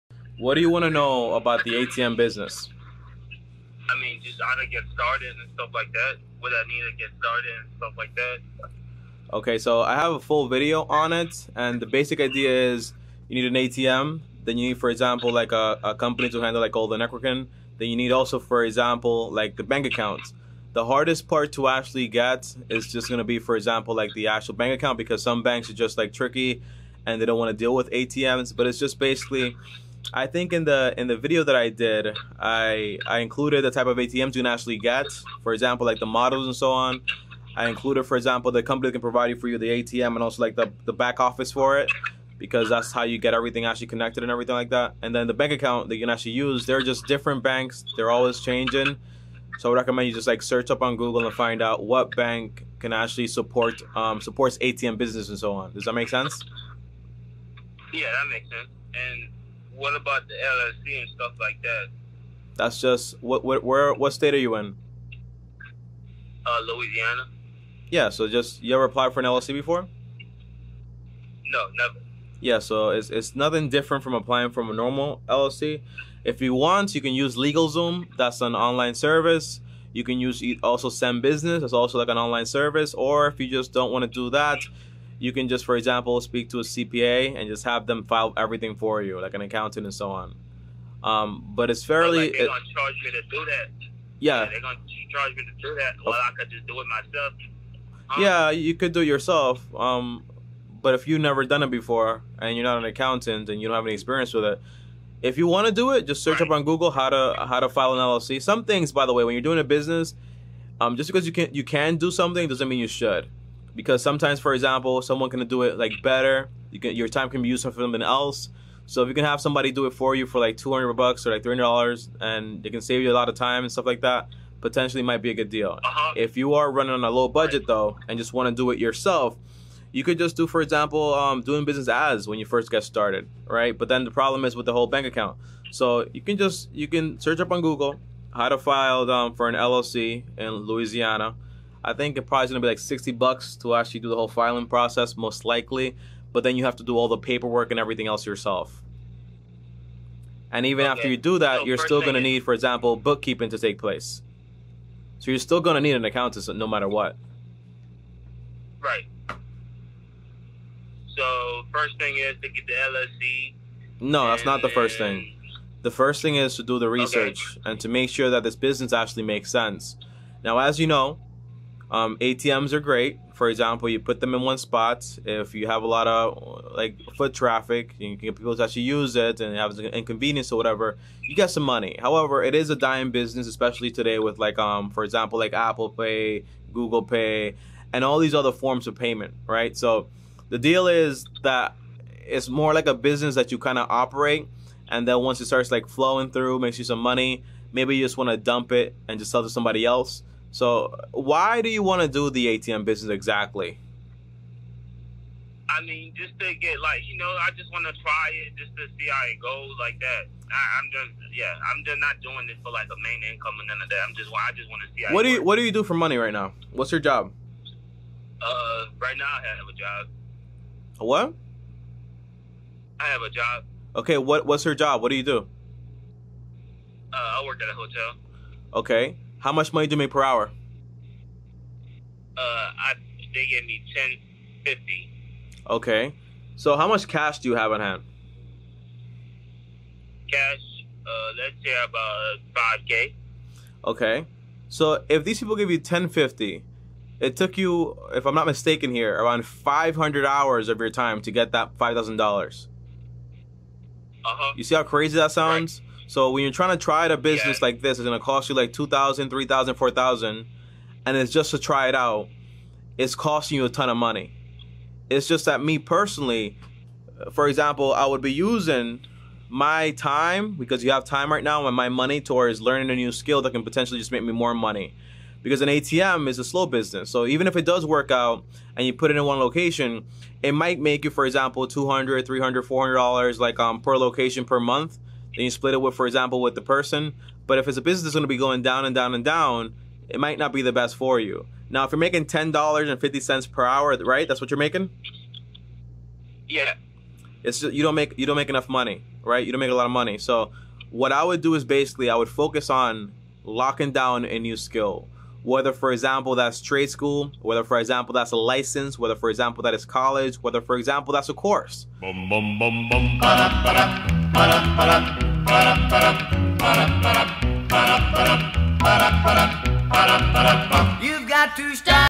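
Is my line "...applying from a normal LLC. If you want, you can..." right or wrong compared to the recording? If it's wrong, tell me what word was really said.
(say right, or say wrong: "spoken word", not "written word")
right.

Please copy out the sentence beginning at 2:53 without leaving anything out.
For example, you put them in one spot.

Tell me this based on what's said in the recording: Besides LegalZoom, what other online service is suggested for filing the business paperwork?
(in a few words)
ZenBusiness.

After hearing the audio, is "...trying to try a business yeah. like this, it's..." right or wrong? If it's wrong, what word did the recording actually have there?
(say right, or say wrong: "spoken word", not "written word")
right.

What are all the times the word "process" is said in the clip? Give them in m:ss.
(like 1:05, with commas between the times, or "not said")
2:24.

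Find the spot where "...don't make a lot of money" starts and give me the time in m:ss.
4:59.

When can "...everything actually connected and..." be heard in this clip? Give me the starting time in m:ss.
0:43.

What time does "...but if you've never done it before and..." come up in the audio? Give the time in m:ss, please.
1:40.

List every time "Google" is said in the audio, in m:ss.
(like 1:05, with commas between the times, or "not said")
0:50, 1:46, 2:17, 3:06.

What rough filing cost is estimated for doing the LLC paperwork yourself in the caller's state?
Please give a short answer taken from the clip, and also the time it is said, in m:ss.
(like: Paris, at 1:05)
$60, at 2:22.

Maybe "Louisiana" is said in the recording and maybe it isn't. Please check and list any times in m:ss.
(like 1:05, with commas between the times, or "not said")
1:06, 2:20.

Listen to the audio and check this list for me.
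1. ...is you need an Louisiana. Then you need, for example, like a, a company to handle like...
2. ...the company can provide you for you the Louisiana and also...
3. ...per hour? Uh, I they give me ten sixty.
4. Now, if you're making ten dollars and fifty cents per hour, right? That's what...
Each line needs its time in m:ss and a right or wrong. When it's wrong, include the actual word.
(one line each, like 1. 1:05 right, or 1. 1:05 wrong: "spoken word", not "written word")
1. 0:12 wrong: "ATM", not "Louisiana"
2. 0:38 wrong: "ATM", not "Louisiana"
3. 3:50 wrong: "fifty", not "sixty"
4. 4:51 right.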